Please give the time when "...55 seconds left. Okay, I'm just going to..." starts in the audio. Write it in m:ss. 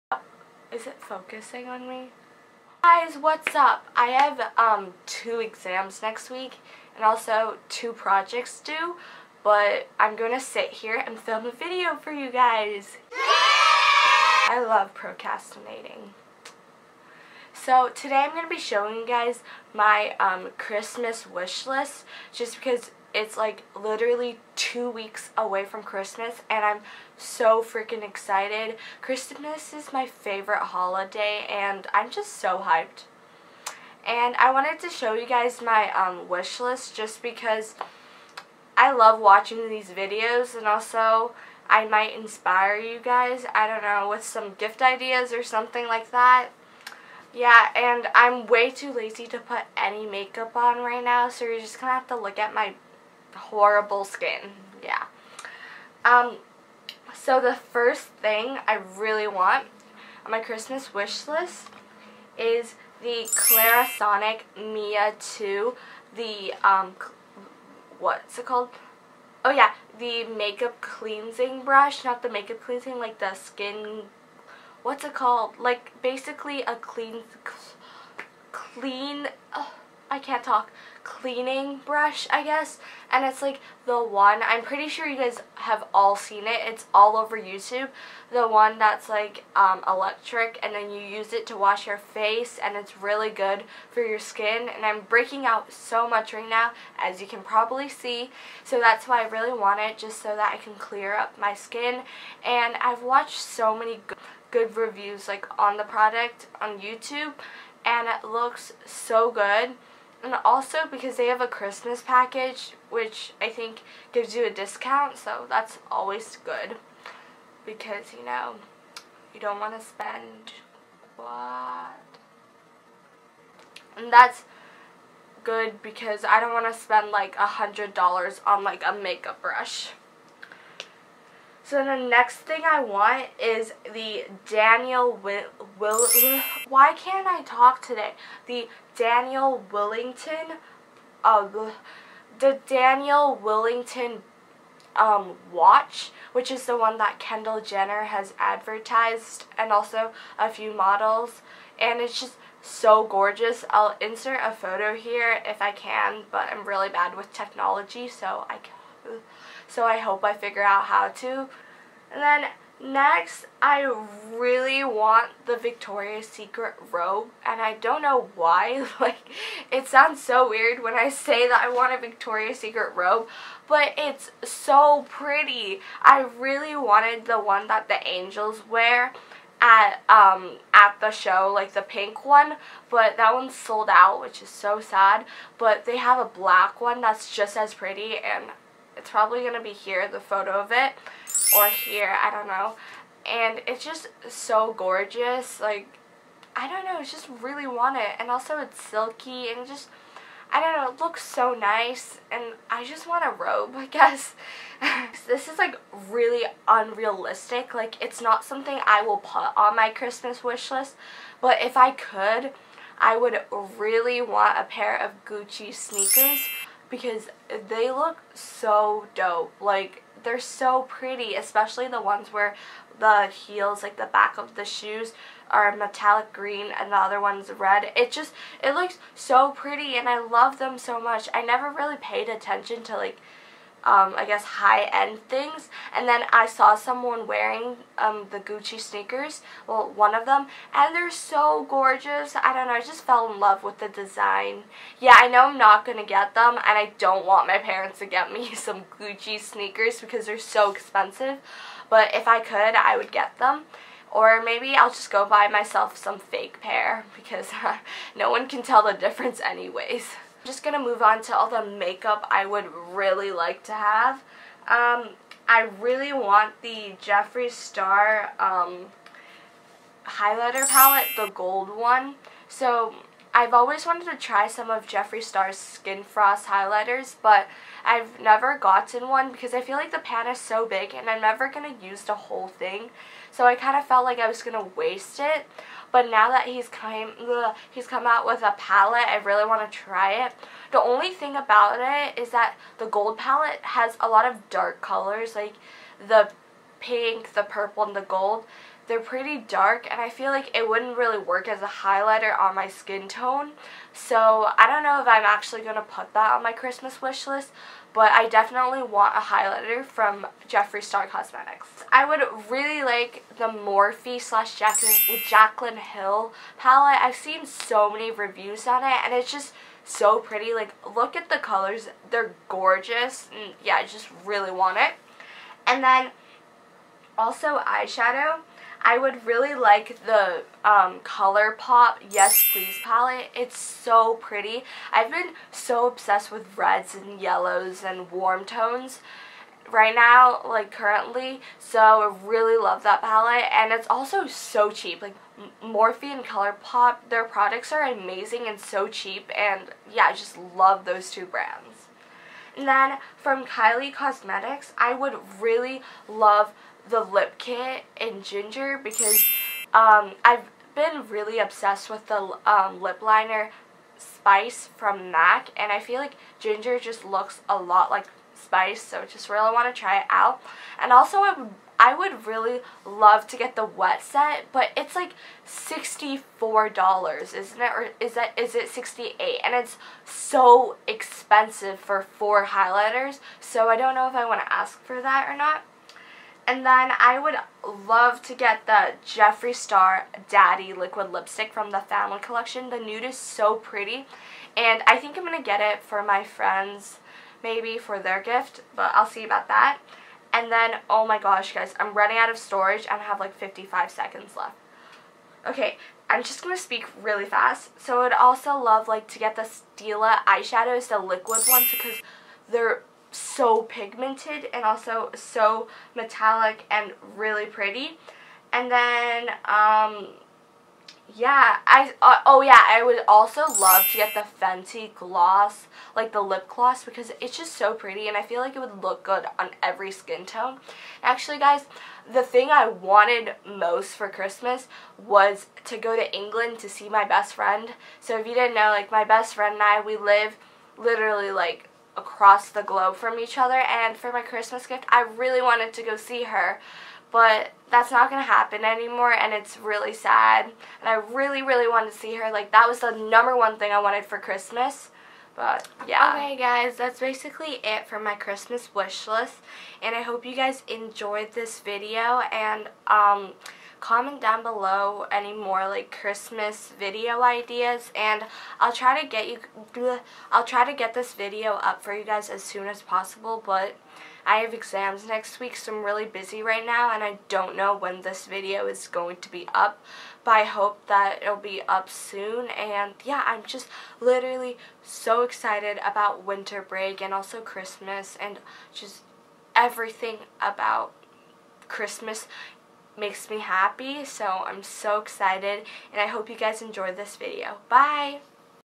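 6:43.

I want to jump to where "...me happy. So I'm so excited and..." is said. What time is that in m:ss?
8:13.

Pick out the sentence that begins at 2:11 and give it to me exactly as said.
So the next thing I want is the Daniel Will, Will why can't I talk today?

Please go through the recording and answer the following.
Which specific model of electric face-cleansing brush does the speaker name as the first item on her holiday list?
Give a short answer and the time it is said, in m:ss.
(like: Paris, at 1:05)
Clarisonic Mia 2, at 1:03.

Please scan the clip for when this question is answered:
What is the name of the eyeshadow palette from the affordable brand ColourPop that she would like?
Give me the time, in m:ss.
5:32.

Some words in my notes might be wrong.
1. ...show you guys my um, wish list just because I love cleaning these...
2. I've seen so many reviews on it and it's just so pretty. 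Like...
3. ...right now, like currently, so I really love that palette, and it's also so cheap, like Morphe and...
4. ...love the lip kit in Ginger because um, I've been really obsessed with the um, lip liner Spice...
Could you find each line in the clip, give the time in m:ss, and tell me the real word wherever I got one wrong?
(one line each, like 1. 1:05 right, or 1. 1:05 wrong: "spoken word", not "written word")
1. 0:34 wrong: "watching", not "cleaning"
2. 5:17 right
3. 5:39 right
4. 5:56 right.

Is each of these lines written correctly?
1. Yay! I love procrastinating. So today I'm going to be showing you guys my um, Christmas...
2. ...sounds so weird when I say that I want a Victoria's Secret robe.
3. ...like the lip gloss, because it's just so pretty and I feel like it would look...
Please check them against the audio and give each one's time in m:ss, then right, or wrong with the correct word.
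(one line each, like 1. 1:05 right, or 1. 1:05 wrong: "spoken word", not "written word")
1. 0:13 right
2. 2:49 right
3. 7:05 right.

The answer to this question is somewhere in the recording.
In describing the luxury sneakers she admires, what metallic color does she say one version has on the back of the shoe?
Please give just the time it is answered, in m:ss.
3:45.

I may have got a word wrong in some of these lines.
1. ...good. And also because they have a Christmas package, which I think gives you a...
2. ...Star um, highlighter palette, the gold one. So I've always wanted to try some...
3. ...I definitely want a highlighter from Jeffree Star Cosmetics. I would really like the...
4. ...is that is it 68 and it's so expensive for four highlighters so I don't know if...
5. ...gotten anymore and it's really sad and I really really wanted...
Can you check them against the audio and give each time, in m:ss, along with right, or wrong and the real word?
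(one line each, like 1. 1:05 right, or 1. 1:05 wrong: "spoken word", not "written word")
1. 1:49 right
2. 4:27 right
3. 5:08 right
4. 6:17 right
5. 7:28 wrong: "happen", not "gotten".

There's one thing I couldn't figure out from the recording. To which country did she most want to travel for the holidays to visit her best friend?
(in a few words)
England.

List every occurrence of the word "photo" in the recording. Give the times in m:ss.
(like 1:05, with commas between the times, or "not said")
2:34, 3:10.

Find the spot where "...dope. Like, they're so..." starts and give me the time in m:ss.
3:39.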